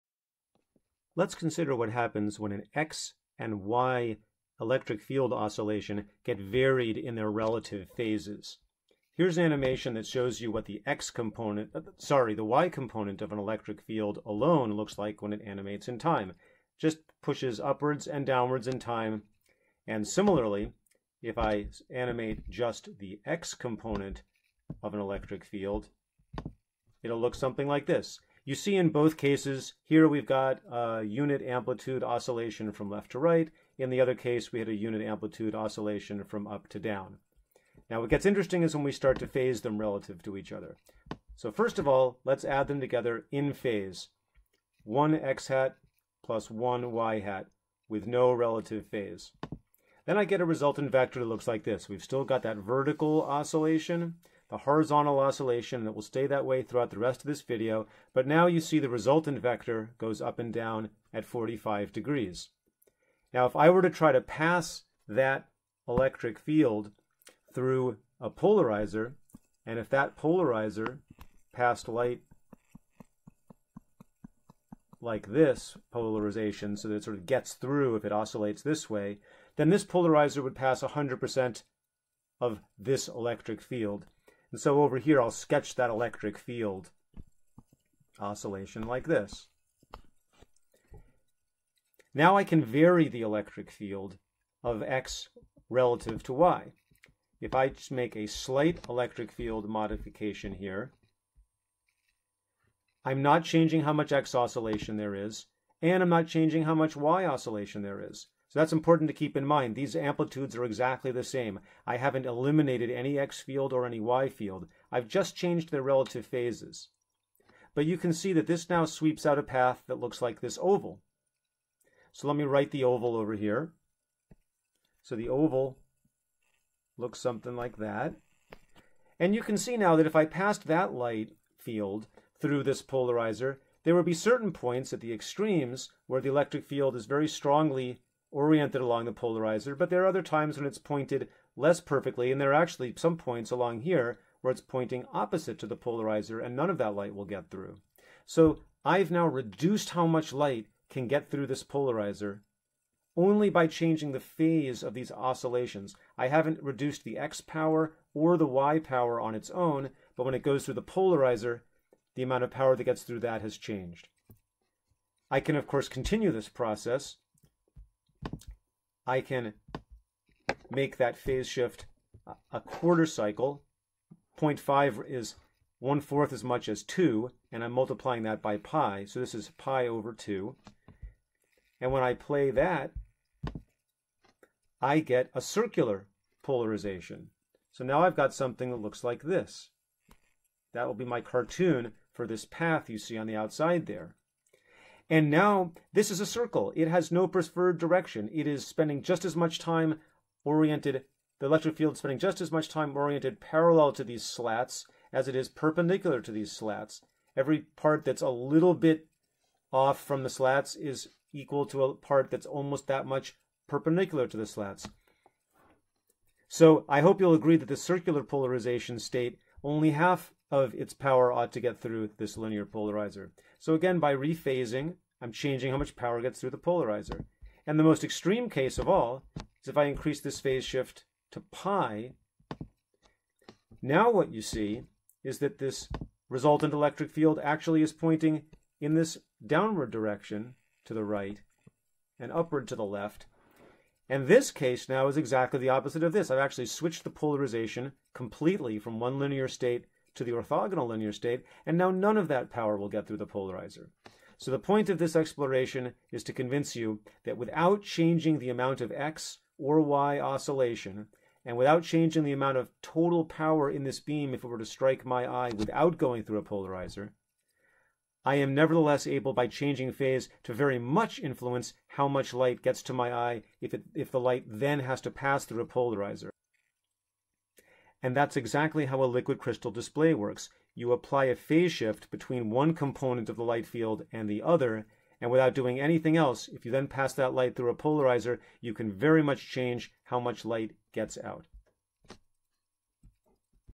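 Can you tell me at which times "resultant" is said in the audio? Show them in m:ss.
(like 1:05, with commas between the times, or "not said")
0:50, 0:58, 3:56.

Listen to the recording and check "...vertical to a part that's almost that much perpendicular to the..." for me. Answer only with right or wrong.
wrong.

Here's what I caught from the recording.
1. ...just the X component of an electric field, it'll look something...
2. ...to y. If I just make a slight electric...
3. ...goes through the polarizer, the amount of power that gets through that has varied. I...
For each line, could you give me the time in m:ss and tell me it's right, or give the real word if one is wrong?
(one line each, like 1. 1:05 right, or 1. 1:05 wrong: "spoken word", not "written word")
1. 0:22 right
2. 1:36 right
3. 2:40 wrong: "changed", not "varied".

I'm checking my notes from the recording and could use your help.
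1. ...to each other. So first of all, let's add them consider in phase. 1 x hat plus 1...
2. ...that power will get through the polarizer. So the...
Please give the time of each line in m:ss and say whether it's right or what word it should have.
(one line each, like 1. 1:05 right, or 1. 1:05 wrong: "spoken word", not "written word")
1. 0:40 wrong: "together", not "consider"
2. 4:12 right.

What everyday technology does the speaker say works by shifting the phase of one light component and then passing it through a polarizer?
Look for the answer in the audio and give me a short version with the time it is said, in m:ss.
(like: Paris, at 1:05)
Liquid crystal display, at 4:39.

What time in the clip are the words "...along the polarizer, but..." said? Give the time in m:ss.
2:18.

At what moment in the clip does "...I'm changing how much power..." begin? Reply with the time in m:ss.
3:45.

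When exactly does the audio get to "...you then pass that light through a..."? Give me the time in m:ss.
4:46.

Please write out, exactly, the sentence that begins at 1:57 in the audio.
But you can see that this now sweeps out a path that looks like this oval.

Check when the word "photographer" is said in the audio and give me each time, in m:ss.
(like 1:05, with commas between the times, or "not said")
not said.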